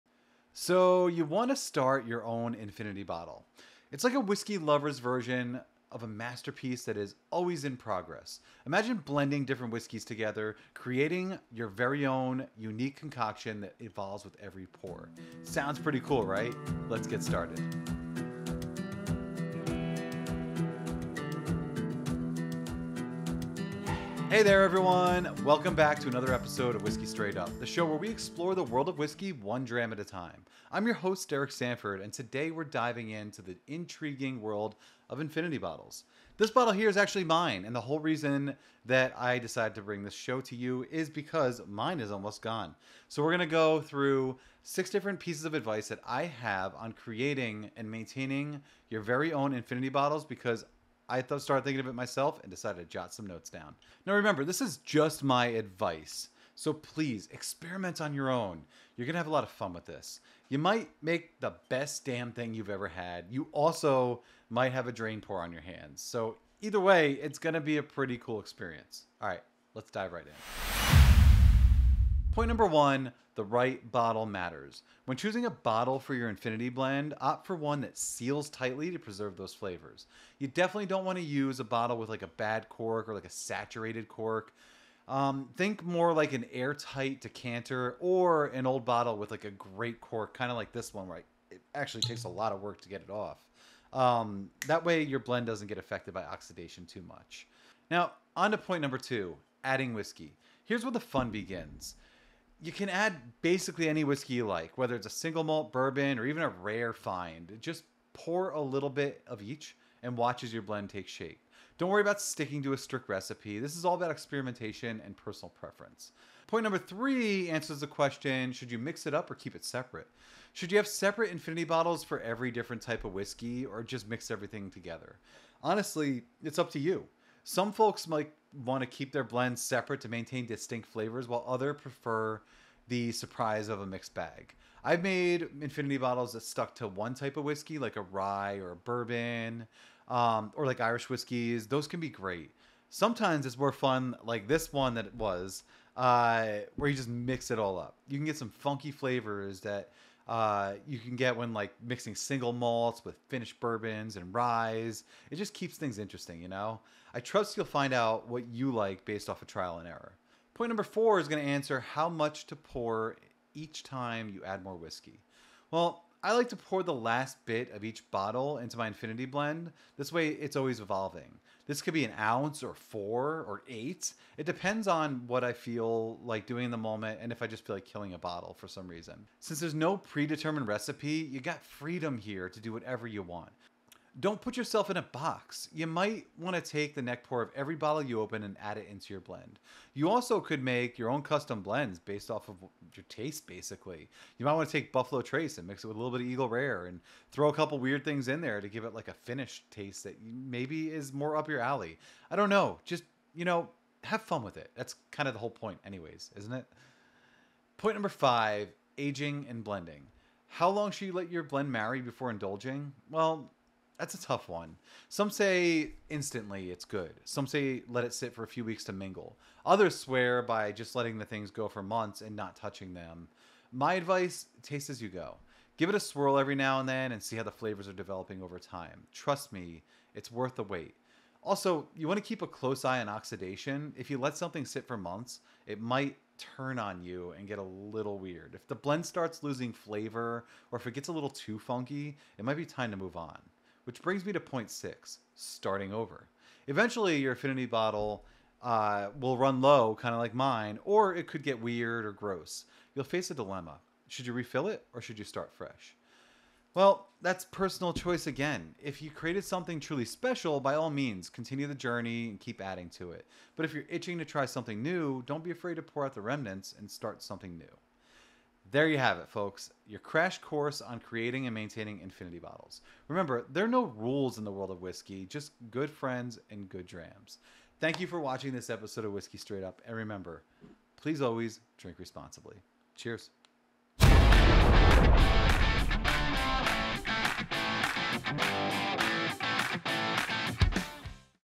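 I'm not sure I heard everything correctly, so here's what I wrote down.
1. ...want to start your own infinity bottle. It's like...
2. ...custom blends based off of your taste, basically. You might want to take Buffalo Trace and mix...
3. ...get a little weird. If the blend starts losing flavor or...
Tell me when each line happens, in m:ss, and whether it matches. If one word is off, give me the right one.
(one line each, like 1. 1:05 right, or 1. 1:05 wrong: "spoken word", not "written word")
1. 0:01 right
2. 3:11 right
3. 3:57 right.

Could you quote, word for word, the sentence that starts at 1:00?
You might make the best damn thing you've ever had.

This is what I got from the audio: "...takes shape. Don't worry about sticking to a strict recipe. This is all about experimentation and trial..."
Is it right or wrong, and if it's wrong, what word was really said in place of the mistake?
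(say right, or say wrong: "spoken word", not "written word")
wrong: "personal", not "trial".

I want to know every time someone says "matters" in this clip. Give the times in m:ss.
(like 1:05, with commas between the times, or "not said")
1:14.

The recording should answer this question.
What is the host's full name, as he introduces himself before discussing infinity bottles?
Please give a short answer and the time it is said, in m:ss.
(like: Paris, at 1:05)
Derek Sanford, at 0:31.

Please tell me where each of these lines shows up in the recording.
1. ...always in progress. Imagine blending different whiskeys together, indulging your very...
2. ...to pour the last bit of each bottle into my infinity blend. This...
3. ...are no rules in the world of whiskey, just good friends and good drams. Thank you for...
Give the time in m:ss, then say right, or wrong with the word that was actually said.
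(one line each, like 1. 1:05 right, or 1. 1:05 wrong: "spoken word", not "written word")
1. 0:07 wrong: "creating", not "indulging"
2. 2:46 right
3. 4:33 right.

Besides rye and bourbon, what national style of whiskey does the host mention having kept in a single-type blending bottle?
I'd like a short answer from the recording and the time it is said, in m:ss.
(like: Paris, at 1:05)
Irish whiskeys, at 2:20.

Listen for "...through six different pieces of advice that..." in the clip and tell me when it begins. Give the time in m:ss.
0:43.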